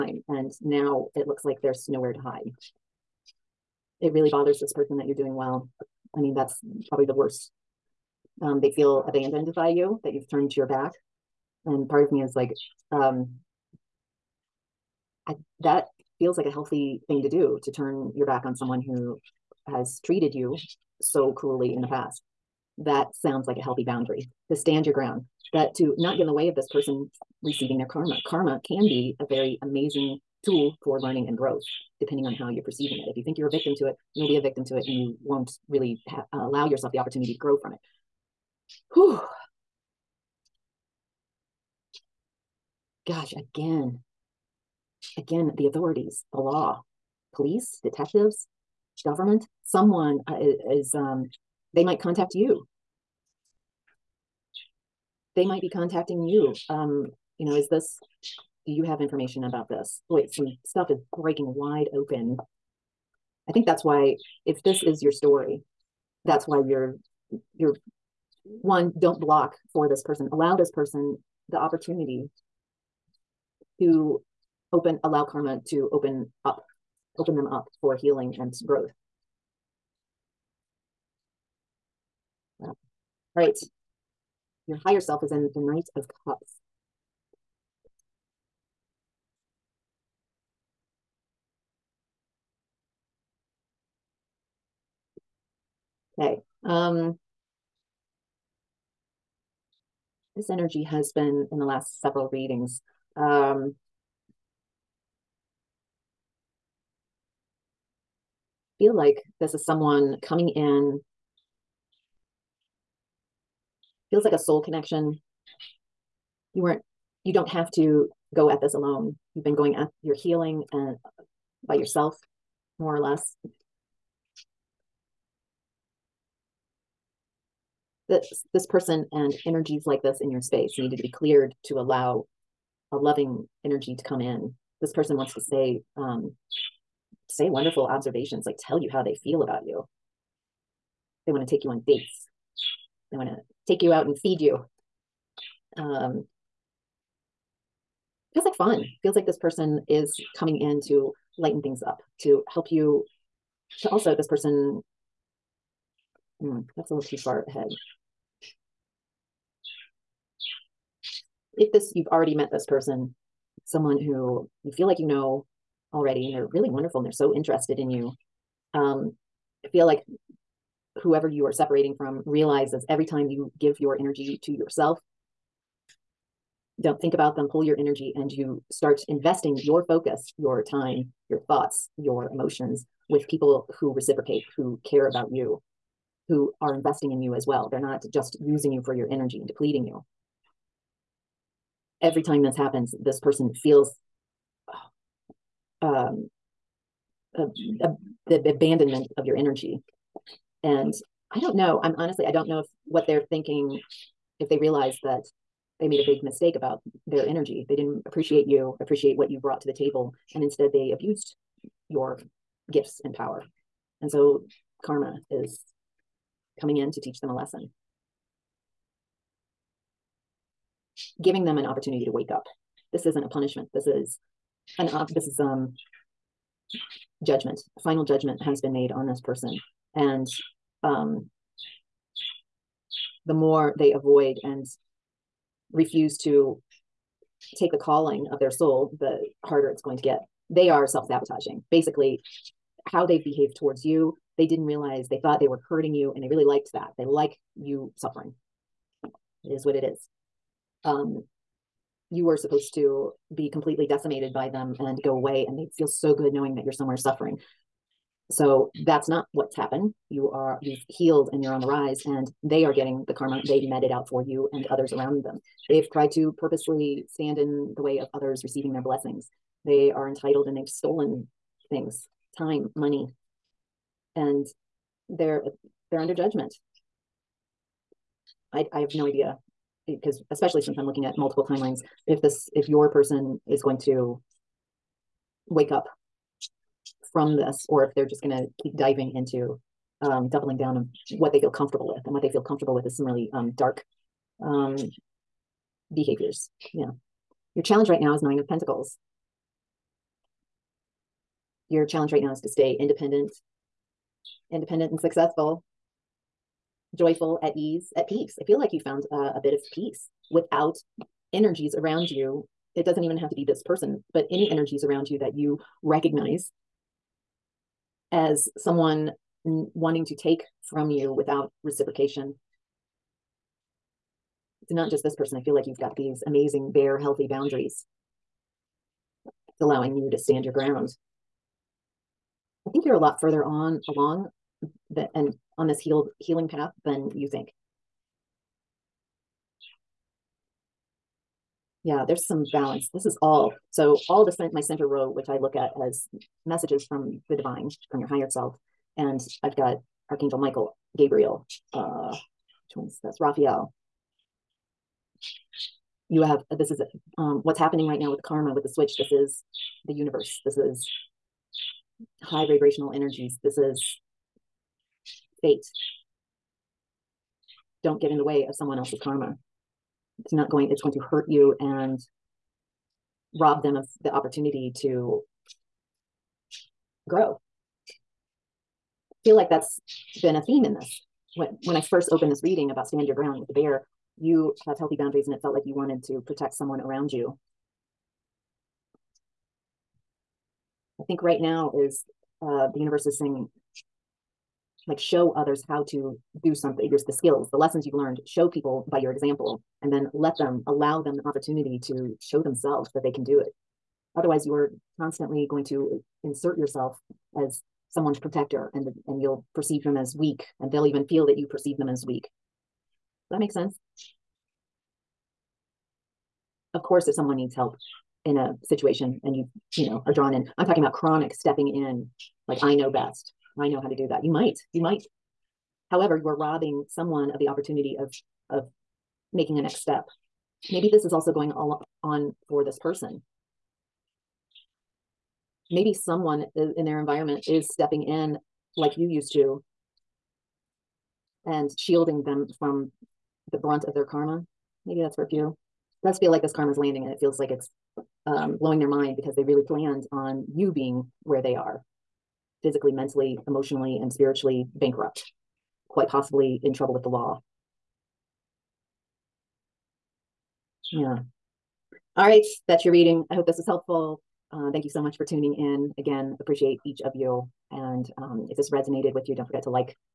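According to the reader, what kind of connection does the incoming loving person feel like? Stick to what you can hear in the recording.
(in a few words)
Soul connection.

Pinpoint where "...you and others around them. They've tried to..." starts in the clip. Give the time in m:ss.
4:24.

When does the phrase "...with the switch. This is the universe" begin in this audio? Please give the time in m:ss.
5:58.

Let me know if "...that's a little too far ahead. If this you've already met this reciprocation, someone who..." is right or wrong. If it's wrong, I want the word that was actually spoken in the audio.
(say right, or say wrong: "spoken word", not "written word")
wrong: "person", not "reciprocation".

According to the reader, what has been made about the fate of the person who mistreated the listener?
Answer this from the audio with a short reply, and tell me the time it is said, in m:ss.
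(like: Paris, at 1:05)
Final judgment, at 3:47.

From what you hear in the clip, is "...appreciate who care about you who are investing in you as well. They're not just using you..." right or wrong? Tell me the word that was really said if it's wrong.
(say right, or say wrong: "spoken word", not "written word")
wrong: "reciprocate", not "appreciate".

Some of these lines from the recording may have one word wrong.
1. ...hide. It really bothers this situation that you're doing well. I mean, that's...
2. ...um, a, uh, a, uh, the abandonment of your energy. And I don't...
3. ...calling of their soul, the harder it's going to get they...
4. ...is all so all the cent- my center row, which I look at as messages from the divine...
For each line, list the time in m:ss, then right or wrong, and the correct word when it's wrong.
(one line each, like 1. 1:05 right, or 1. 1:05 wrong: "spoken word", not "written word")
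1. 0:02 wrong: "person", not "situation"
2. 3:15 right
3. 3:57 right
4. 5:43 right.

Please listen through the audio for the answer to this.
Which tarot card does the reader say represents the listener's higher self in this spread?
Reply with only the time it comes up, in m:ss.
1:25.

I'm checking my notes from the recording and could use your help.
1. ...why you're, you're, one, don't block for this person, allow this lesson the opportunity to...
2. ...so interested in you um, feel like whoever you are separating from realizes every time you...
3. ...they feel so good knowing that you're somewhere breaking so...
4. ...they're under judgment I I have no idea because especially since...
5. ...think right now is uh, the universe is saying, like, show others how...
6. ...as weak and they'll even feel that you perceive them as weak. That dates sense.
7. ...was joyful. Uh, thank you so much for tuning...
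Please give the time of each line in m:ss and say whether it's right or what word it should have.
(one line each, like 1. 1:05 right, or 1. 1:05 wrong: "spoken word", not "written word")
1. 1:06 wrong: "person", not "lesson"
2. 2:47 right
3. 4:15 wrong: "suffering", not "breaking"
4. 4:35 right
5. 6:31 right
6. 6:49 wrong: "makes", not "dates"
7. 7:43 wrong: "helpful", not "joyful".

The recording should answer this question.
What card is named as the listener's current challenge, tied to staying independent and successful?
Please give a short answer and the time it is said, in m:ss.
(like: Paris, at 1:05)
Nine of Pentacles, at 4:58.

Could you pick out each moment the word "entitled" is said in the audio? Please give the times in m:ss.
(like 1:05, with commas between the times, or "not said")
4:30.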